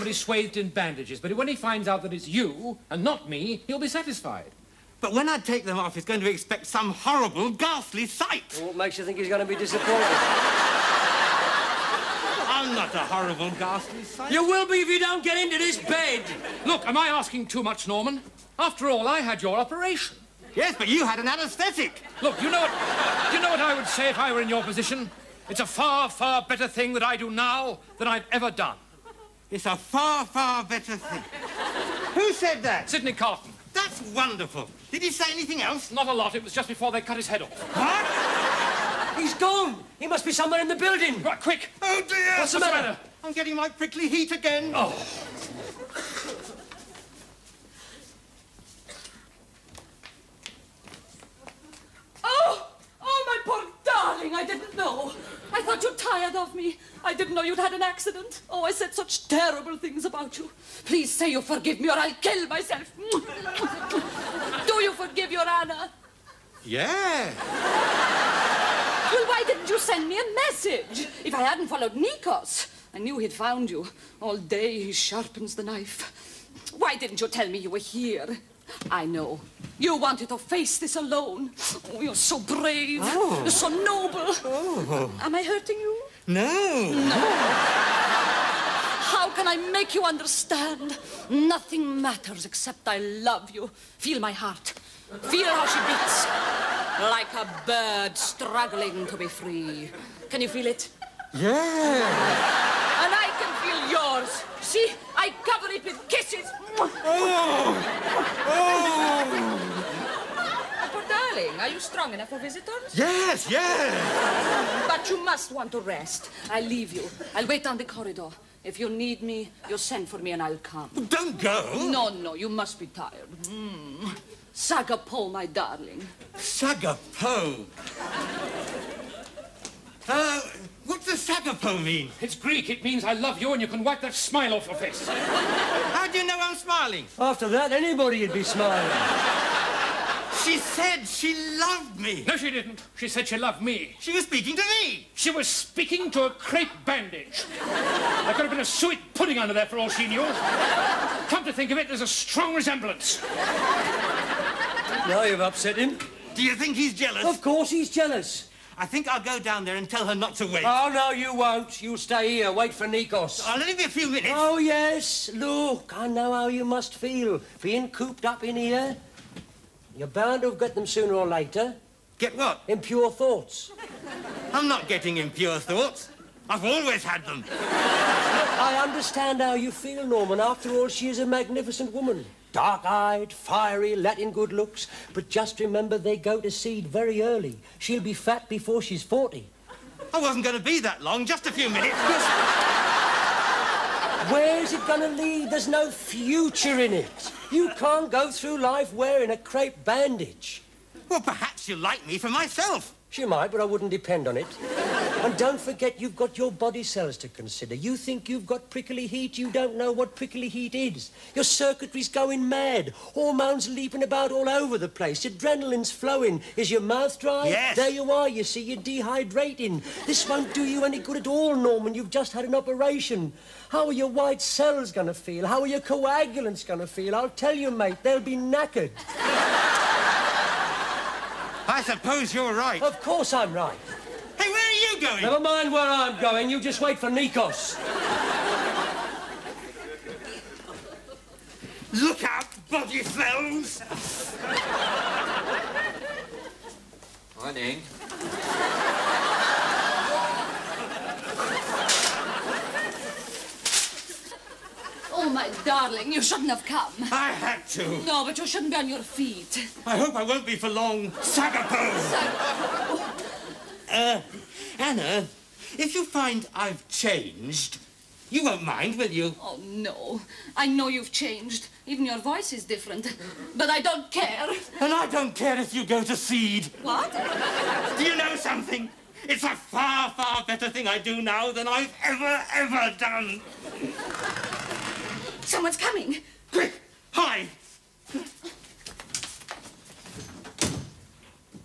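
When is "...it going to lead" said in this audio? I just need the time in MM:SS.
03:14.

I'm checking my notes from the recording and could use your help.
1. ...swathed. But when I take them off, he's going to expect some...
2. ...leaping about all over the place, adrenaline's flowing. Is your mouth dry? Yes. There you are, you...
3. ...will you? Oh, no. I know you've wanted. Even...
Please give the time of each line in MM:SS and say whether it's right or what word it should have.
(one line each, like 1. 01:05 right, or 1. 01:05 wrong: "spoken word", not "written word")
1. 00:03 wrong: "satisfied", not "swathed"
2. 03:33 right
3. 04:28 wrong: "changed", not "wanted".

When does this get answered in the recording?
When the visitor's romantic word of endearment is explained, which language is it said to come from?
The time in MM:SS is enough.
02:12.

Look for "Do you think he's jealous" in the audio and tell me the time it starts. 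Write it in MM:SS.
02:36.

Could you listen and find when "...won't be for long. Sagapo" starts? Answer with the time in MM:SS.
04:20.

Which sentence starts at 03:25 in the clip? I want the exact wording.
And don't forget, you've got your body cells to consider.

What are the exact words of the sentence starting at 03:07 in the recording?
She'll be fat before she's 40.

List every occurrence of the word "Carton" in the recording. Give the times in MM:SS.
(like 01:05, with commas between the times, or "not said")
00:33.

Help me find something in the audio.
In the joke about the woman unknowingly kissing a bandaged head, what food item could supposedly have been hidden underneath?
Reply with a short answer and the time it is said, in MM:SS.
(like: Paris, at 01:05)
suet pudding, at 02:28.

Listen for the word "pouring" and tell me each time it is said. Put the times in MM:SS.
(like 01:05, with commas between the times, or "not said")
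not said.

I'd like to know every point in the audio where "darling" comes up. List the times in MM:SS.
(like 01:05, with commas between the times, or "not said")
00:53, 01:51, 02:05, 04:15.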